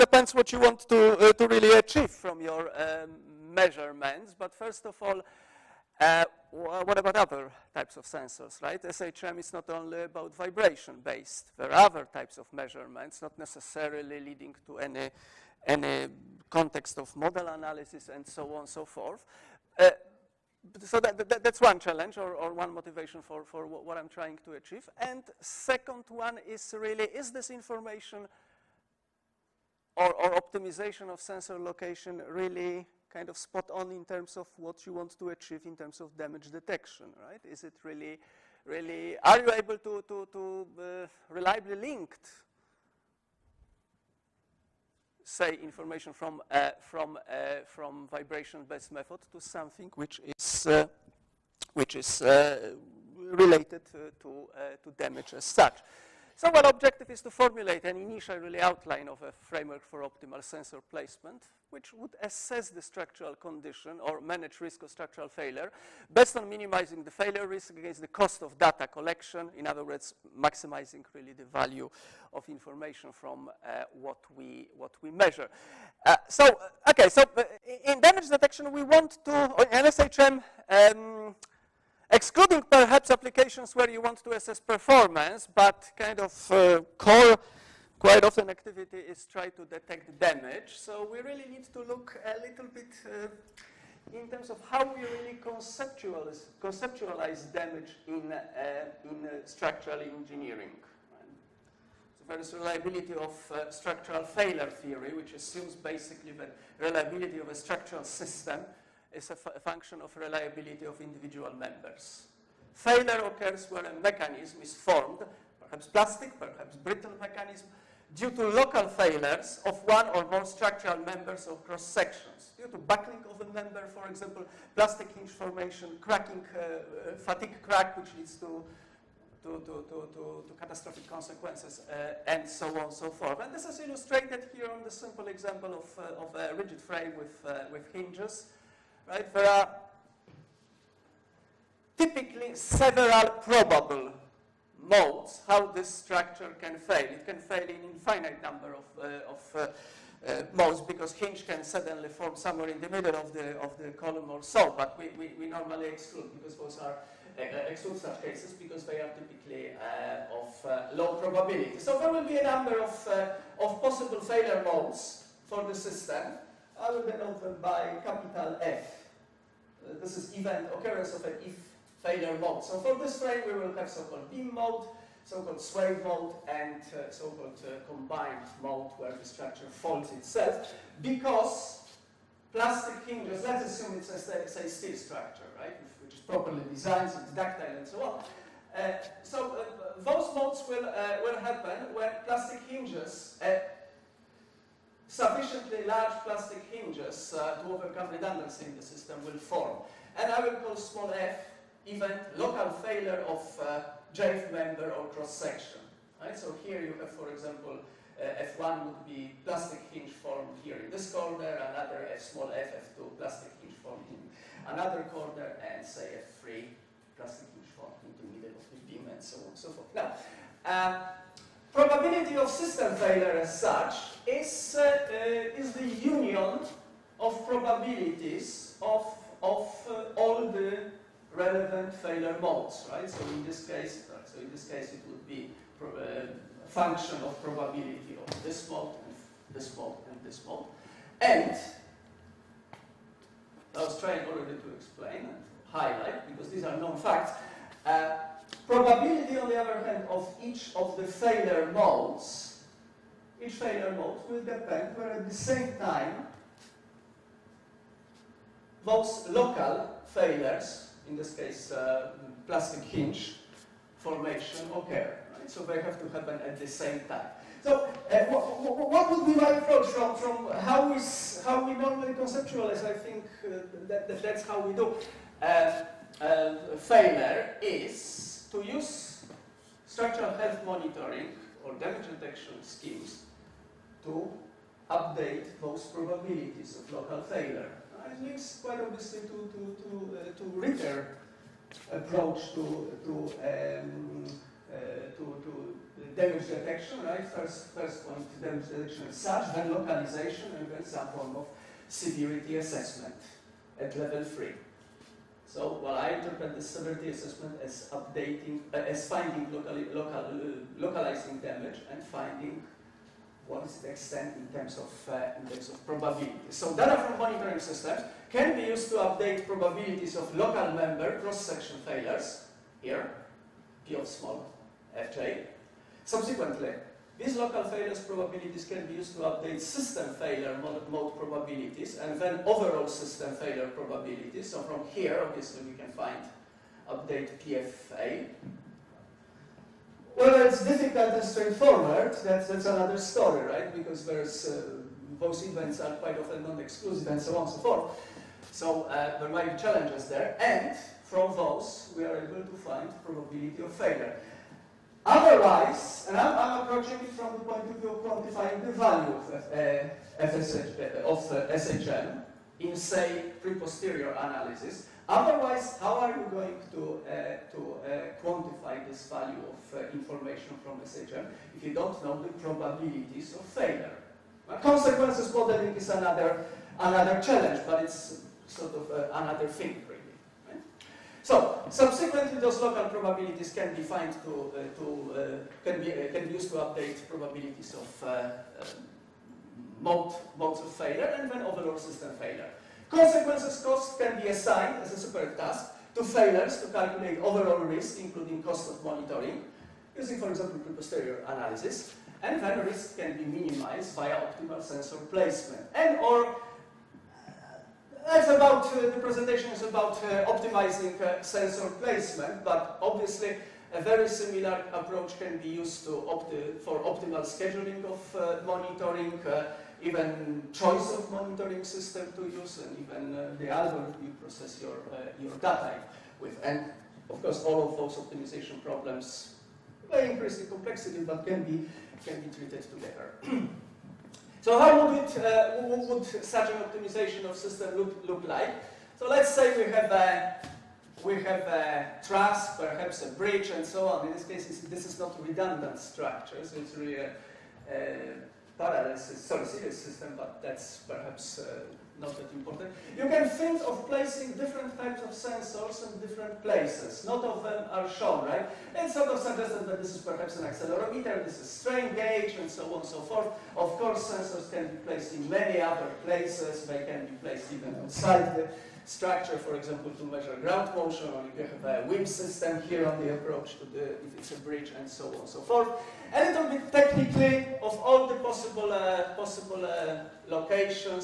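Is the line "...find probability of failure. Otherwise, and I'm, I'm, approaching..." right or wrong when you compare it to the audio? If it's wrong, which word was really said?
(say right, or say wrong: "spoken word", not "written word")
right.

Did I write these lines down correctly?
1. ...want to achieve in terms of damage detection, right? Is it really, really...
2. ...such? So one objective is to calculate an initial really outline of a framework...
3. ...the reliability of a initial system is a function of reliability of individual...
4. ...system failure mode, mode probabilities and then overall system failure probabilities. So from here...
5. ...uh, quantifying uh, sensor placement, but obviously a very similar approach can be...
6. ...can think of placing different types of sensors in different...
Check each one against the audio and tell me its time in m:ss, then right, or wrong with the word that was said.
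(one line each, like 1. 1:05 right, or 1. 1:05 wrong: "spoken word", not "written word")
1. 0:34 right
2. 0:55 wrong: "formulate", not "calculate"
3. 1:46 wrong: "structural", not "initial"
4. 5:29 right
5. 6:50 wrong: "optimizing", not "quantifying"
6. 7:33 right.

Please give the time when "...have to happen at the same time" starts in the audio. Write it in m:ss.
4:25.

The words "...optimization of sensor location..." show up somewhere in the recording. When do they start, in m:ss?
0:30.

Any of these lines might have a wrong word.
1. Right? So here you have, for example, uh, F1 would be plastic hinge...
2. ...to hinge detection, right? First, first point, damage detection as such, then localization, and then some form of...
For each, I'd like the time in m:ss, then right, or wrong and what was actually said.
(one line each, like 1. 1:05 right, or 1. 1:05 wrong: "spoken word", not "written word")
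1. 3:26 right
2. 4:55 wrong: "damage", not "hinge".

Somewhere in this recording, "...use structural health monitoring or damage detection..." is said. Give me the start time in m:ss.
4:38.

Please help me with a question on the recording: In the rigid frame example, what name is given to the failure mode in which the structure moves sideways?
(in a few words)
sway mode.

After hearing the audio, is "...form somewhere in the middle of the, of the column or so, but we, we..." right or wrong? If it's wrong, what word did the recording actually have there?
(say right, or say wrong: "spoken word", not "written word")
right.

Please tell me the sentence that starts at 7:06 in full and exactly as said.
And of course, all of those optimization problems may increase the complexity, but can be, can be treated together.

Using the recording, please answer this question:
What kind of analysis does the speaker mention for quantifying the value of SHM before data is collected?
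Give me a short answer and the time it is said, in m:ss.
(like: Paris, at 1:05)
pre-posterior analysis, at 6:03.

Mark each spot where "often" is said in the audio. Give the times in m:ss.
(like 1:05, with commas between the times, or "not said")
1:28, 5:46.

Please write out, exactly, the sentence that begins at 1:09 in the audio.
In other words, maximizing really the value of information from uh, what, we, what we measure.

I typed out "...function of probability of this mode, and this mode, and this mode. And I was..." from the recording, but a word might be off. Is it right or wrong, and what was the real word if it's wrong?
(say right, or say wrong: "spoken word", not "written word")
right.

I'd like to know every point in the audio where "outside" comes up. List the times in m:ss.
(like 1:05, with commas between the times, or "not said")
7:47.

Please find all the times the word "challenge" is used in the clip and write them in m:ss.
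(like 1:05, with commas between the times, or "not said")
0:21, 5:49, 6:17.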